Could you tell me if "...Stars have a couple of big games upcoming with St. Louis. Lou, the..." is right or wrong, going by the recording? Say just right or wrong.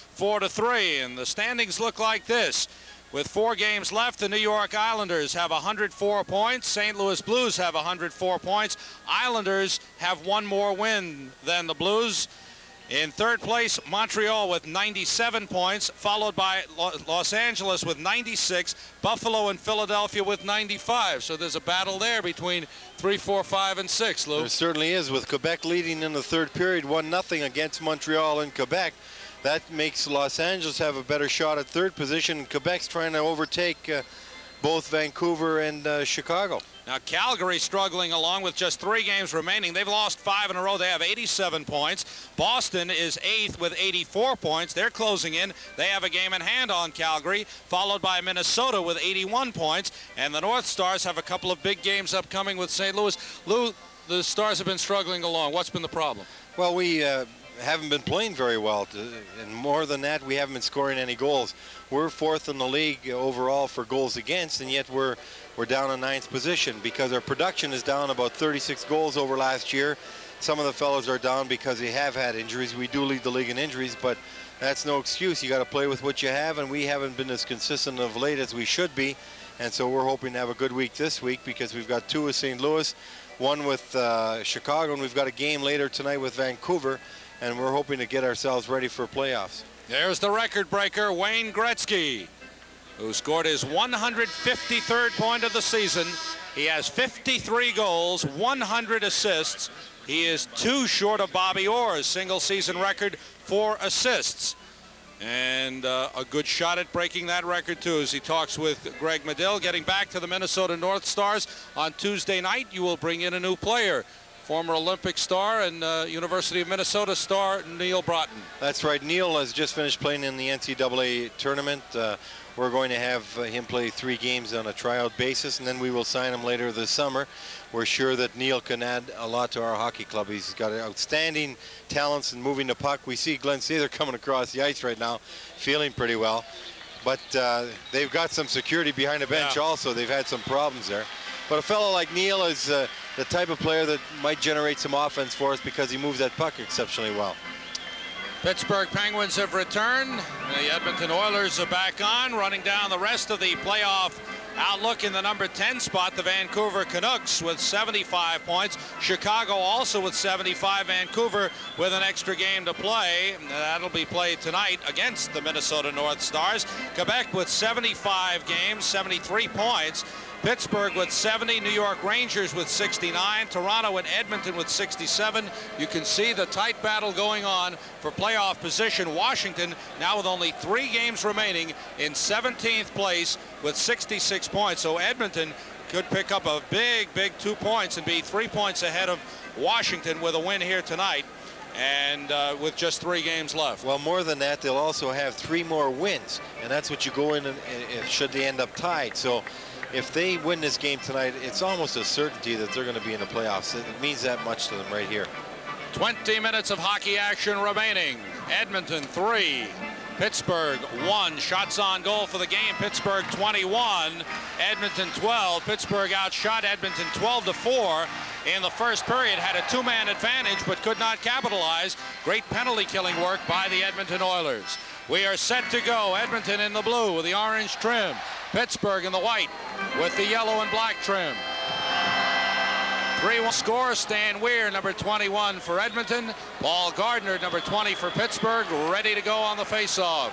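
right.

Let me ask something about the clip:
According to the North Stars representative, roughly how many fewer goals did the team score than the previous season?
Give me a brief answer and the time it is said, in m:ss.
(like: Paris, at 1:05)
36, at 1:08.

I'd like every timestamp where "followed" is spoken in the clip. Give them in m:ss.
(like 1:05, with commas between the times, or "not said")
0:15, 0:47.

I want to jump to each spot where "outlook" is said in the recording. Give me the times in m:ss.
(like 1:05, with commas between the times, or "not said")
2:34.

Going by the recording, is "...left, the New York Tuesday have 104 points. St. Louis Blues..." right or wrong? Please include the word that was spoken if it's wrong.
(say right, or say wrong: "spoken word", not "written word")
wrong: "Islanders", not "Tuesday".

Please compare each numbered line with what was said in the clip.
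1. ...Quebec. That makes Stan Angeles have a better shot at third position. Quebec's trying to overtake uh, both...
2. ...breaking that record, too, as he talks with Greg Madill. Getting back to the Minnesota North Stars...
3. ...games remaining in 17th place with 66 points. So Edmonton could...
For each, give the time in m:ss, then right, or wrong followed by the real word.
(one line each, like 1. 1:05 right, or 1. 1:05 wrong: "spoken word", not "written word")
1. 0:28 wrong: "Los", not "Stan"
2. 1:46 right
3. 3:00 right.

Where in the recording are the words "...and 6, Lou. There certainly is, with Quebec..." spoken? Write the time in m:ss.
0:23.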